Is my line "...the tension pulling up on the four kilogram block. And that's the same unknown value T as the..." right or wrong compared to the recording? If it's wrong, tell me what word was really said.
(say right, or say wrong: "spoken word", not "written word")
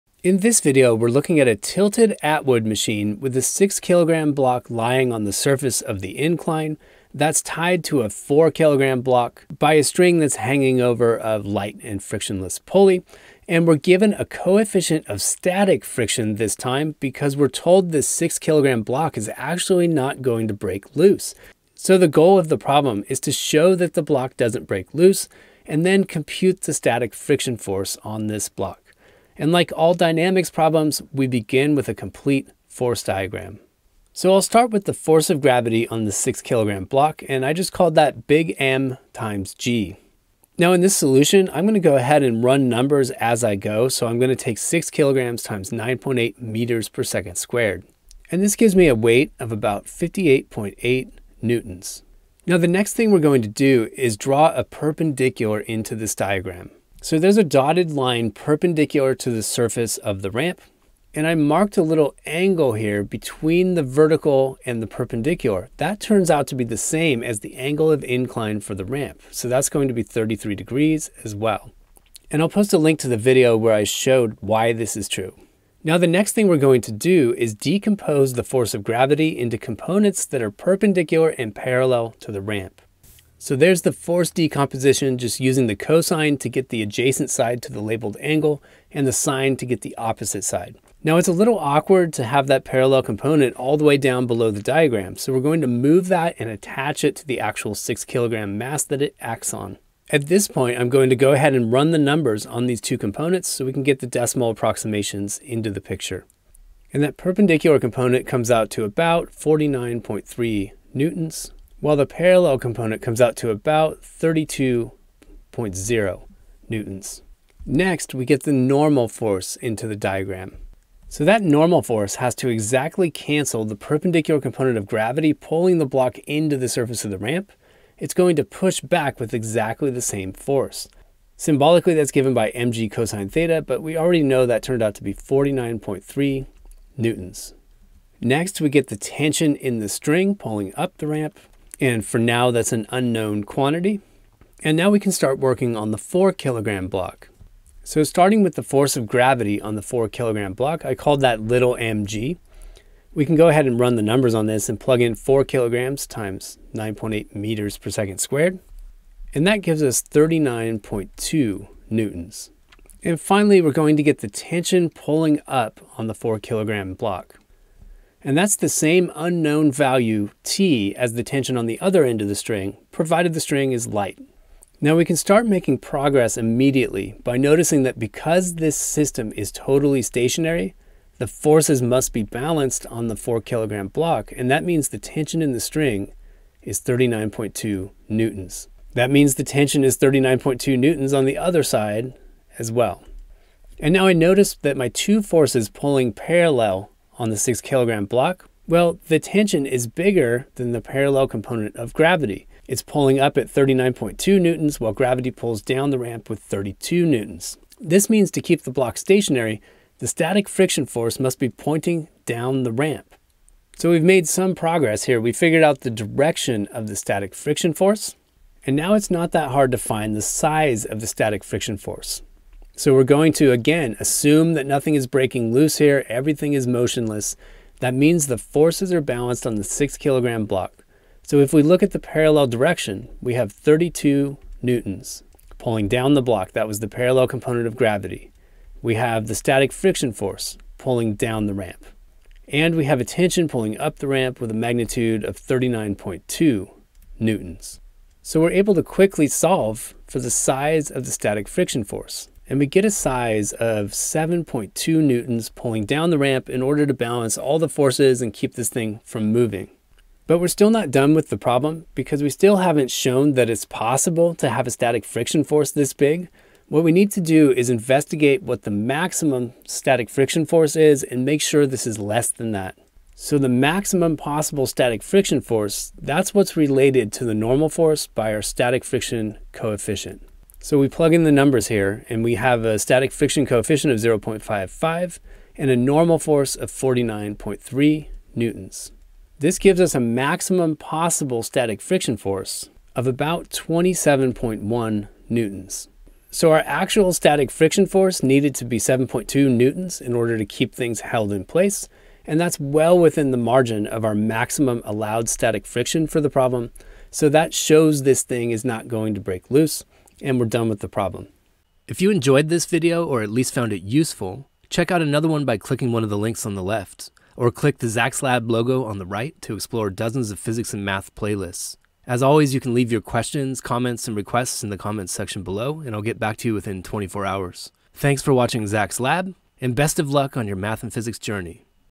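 right.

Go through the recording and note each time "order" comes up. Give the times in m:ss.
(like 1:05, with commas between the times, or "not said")
4:16, 5:00.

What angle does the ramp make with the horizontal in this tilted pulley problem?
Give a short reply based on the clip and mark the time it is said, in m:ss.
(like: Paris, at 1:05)
33 degrees, at 1:10.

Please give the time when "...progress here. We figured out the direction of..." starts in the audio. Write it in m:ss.
3:34.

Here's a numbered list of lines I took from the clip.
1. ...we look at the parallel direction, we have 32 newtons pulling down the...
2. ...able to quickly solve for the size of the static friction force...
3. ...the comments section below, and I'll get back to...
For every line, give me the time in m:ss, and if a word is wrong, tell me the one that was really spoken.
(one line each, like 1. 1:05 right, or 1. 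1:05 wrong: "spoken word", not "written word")
1. 3:51 right
2. 4:08 right
3. 5:24 right.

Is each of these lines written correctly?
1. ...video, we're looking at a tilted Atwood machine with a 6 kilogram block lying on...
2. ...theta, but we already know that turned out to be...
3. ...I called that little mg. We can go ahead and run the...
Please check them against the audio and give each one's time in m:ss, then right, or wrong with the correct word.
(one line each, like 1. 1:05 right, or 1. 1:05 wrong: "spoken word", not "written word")
1. 0:00 right
2. 2:13 right
3. 2:30 right.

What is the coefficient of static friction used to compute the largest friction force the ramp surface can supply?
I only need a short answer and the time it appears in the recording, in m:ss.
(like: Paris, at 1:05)
0.55, at 4:44.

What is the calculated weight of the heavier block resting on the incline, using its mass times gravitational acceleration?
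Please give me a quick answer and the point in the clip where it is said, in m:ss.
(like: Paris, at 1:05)
58.8 newtons, at 0:49.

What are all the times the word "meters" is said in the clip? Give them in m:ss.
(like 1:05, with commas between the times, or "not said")
0:46, 2:37.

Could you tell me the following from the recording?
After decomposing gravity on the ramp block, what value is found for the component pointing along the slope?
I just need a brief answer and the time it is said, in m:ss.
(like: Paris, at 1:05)
32.0 newtons, at 1:54.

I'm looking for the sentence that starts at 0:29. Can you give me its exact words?
And like all dynamics problems, we begin with a complete force diagram.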